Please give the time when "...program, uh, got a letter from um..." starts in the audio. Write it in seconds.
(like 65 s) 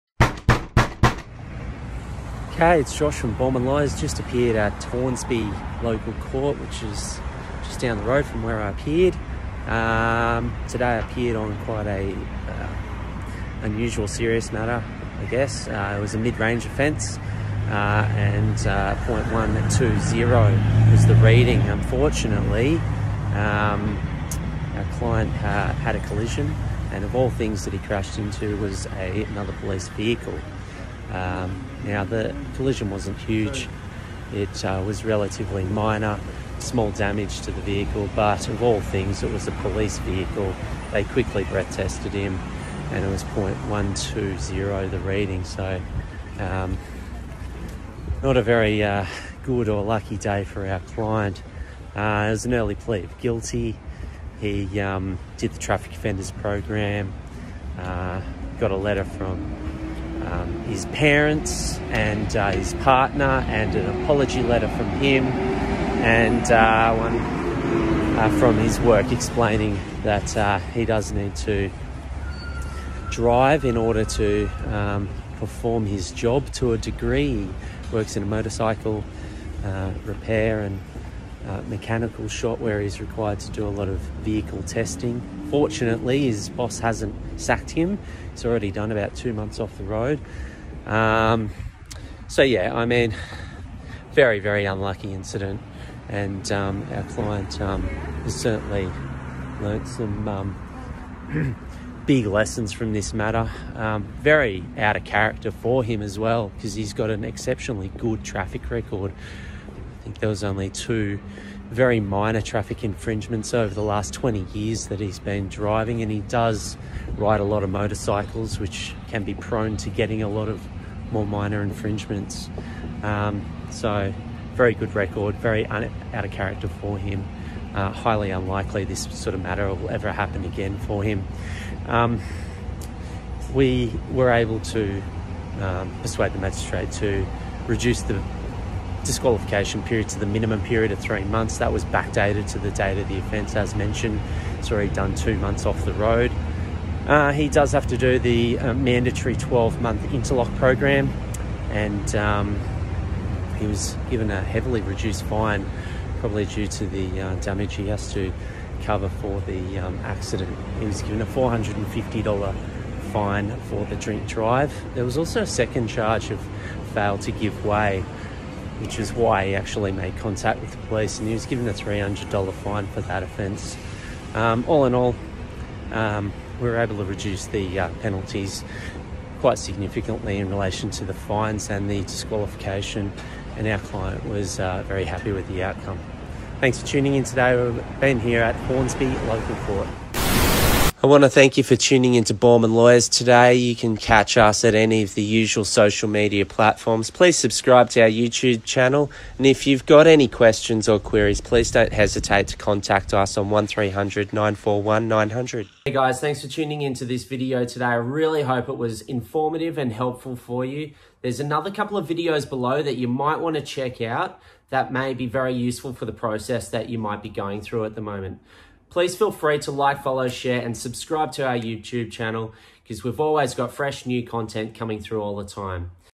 56 s.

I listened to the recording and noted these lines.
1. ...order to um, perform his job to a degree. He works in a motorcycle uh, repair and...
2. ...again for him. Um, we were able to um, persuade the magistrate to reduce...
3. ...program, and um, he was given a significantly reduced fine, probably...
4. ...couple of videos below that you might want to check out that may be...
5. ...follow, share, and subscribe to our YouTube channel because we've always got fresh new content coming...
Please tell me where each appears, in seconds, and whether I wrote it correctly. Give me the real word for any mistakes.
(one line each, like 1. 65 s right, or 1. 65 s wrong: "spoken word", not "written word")
1. 73 s right
2. 130 s right
3. 150 s wrong: "heavily", not "significantly"
4. 211 s right
5. 220 s right.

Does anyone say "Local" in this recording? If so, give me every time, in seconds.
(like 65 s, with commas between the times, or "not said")
5 s, 189 s.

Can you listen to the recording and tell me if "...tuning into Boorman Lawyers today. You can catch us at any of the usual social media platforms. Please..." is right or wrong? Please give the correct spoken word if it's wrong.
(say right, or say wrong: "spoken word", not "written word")
right.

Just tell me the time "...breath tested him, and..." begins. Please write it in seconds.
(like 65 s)
41 s.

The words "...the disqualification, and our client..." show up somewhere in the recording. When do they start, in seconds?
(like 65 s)
181 s.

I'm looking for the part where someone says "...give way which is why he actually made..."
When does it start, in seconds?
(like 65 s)
167 s.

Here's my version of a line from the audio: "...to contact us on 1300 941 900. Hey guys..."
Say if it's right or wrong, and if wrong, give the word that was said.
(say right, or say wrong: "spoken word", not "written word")
right.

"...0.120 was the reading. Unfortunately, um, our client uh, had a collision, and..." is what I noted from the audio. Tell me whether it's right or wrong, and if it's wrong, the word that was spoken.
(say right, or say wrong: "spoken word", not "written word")
right.